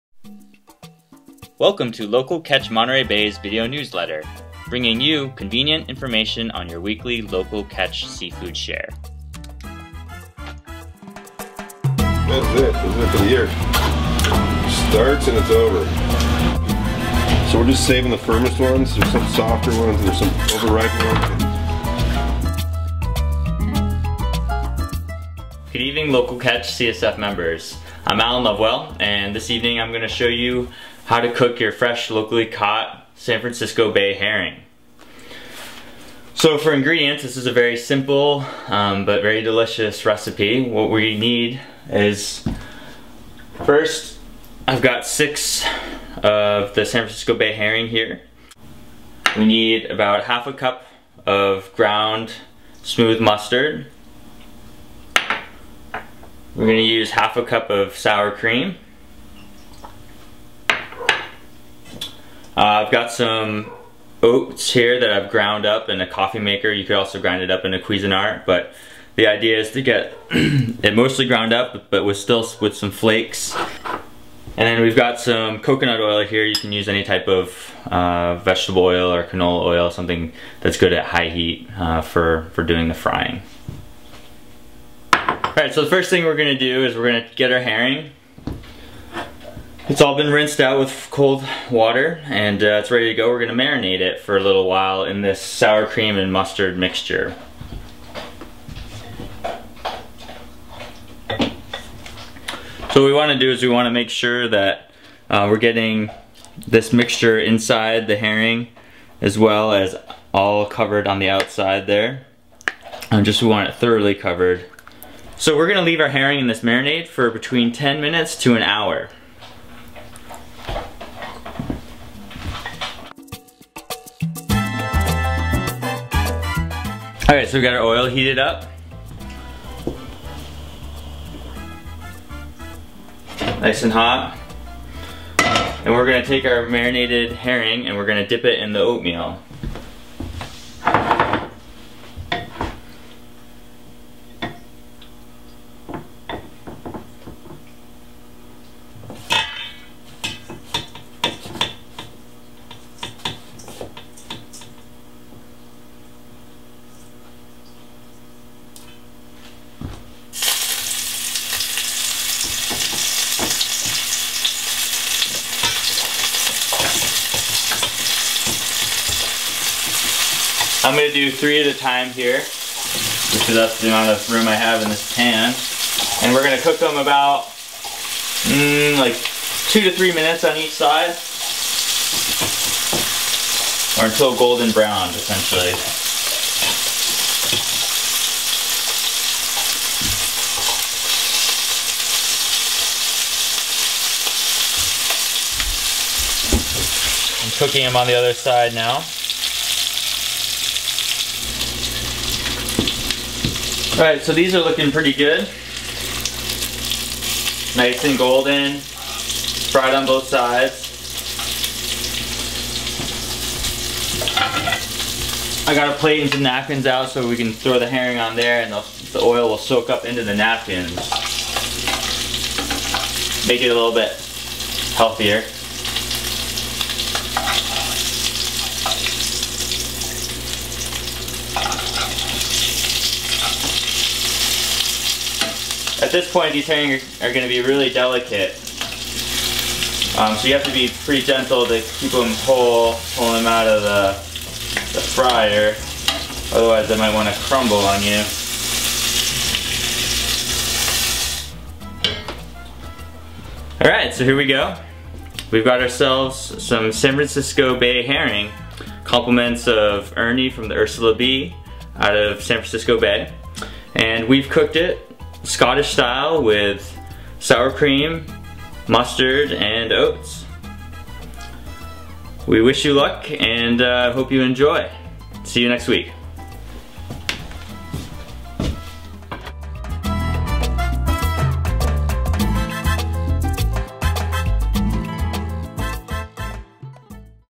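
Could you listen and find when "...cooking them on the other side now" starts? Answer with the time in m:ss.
3:17.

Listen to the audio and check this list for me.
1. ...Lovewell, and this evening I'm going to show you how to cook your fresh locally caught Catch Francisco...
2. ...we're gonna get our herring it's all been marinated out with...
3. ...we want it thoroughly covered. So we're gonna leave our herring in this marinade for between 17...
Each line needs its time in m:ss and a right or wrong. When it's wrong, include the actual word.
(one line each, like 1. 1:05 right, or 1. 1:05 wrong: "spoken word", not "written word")
1. 0:28 wrong: "San", not "Catch"
2. 1:26 wrong: "rinsed", not "marinated"
3. 1:53 wrong: "10", not "17".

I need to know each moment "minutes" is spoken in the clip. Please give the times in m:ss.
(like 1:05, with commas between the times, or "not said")
1:57, 3:00.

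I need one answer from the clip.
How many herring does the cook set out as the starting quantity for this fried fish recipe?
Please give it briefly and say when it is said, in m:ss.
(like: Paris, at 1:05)
6, at 0:45.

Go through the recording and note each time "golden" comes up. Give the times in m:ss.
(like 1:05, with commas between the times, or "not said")
3:04, 3:28.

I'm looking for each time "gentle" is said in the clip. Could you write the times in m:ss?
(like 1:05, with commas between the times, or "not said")
4:01.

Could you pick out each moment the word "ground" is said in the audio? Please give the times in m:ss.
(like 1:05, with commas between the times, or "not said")
0:51, 1:05, 1:11.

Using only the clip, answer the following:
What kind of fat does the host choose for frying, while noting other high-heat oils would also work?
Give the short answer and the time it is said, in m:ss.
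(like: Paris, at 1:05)
Coconut oil, at 1:15.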